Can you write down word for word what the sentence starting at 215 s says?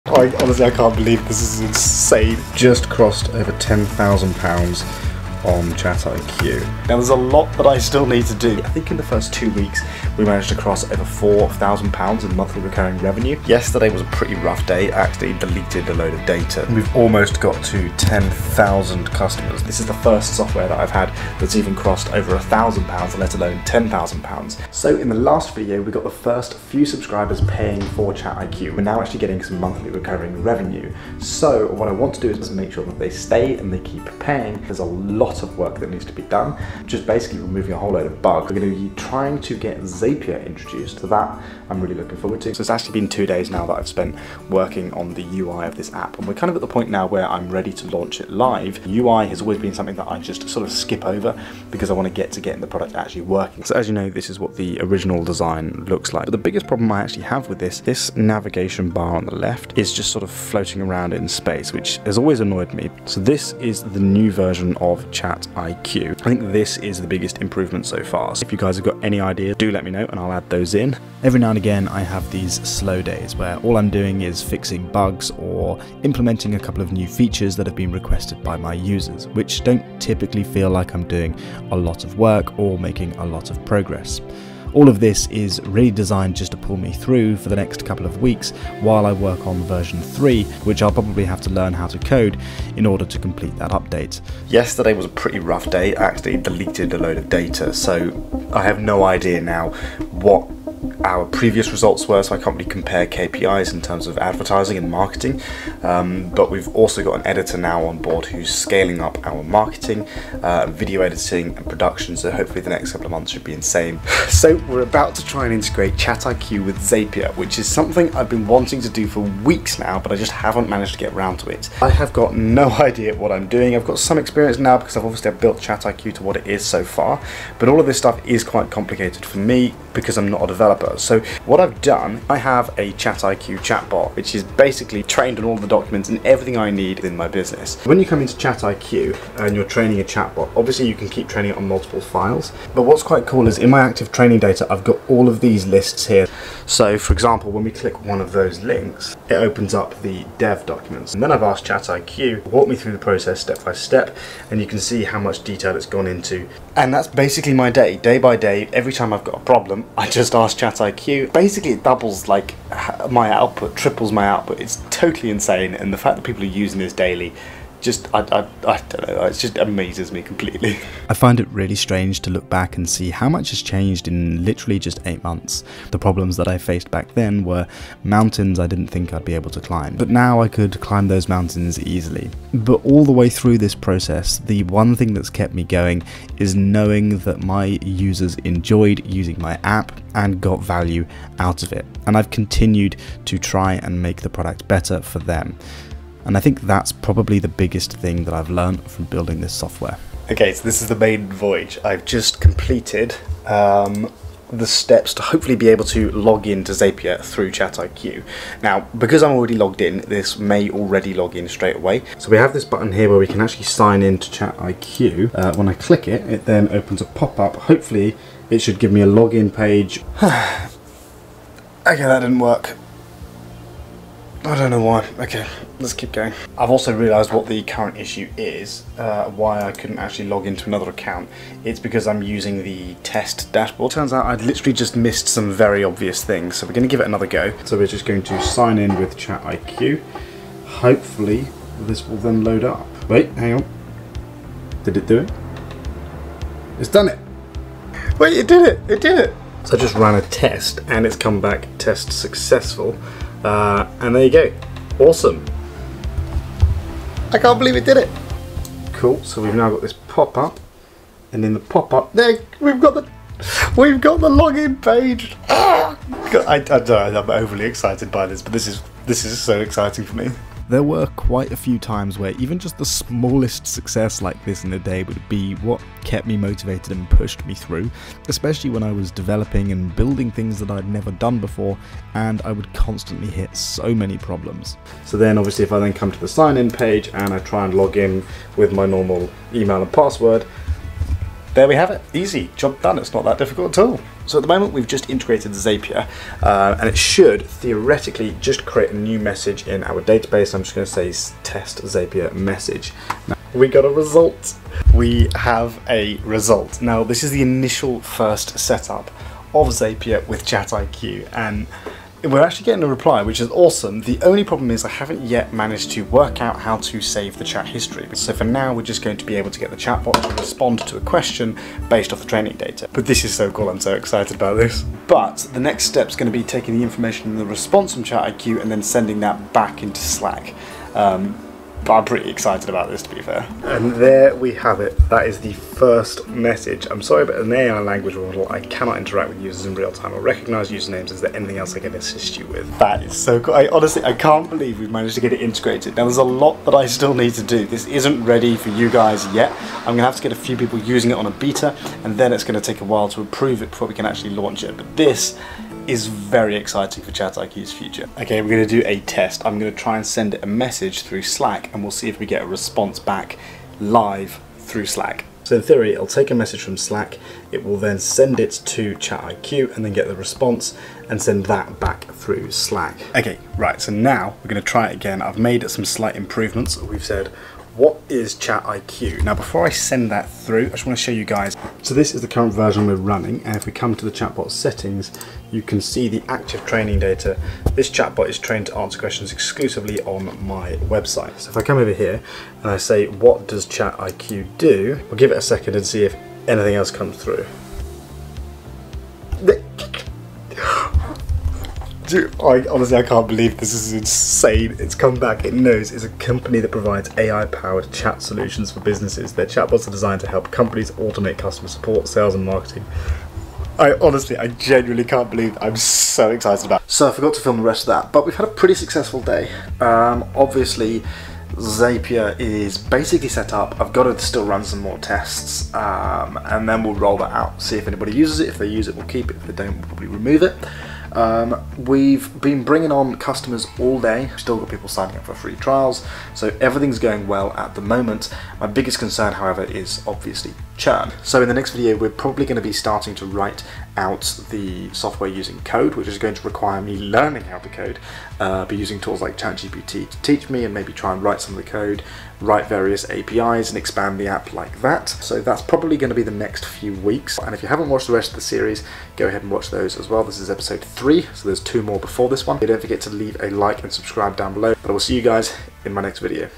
Uh, when I click it, it then opens a pop-up.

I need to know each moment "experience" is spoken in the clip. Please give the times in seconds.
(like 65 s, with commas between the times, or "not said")
124 s.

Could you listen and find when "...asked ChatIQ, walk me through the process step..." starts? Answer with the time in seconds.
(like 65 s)
151 s.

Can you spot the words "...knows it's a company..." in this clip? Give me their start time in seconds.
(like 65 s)
405 s.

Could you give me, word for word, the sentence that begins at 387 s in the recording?
This chatbot is trained to answer questions exclusively on my website.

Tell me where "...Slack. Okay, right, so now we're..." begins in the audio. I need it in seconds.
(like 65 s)
372 s.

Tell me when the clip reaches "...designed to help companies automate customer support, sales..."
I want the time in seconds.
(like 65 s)
409 s.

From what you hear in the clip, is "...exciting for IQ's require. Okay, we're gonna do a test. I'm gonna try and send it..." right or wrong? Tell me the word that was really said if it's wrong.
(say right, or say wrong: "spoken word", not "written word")
wrong: "future", not "require".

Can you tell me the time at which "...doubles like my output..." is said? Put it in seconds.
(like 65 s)
161 s.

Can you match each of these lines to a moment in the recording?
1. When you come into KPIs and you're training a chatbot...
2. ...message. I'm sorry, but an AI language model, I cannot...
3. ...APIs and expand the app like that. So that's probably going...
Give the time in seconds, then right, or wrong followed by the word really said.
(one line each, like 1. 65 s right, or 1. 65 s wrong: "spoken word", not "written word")
1. 137 s wrong: "ChatIQ", not "KPIs"
2. 336 s right
3. 453 s right.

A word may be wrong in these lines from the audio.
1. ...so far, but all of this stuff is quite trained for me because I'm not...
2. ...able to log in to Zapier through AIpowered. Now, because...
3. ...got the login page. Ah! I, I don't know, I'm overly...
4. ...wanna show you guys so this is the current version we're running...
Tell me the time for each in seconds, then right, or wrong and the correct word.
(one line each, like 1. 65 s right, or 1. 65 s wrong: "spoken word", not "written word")
1. 126 s wrong: "complicated", not "trained"
2. 205 s wrong: "ChatIQ", not "AIpowered"
3. 264 s right
4. 380 s right.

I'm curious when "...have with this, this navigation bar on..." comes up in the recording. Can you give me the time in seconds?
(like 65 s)
57 s.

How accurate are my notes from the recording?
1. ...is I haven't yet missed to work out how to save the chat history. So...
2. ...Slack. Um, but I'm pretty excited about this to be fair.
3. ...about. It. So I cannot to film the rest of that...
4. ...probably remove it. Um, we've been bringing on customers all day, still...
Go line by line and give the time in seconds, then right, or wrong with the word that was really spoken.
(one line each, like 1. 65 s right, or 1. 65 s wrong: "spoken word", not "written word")
1. 314 s wrong: "managed", not "missed"
2. 329 s right
3. 416 s wrong: "forgot", not "cannot"
4. 429 s right.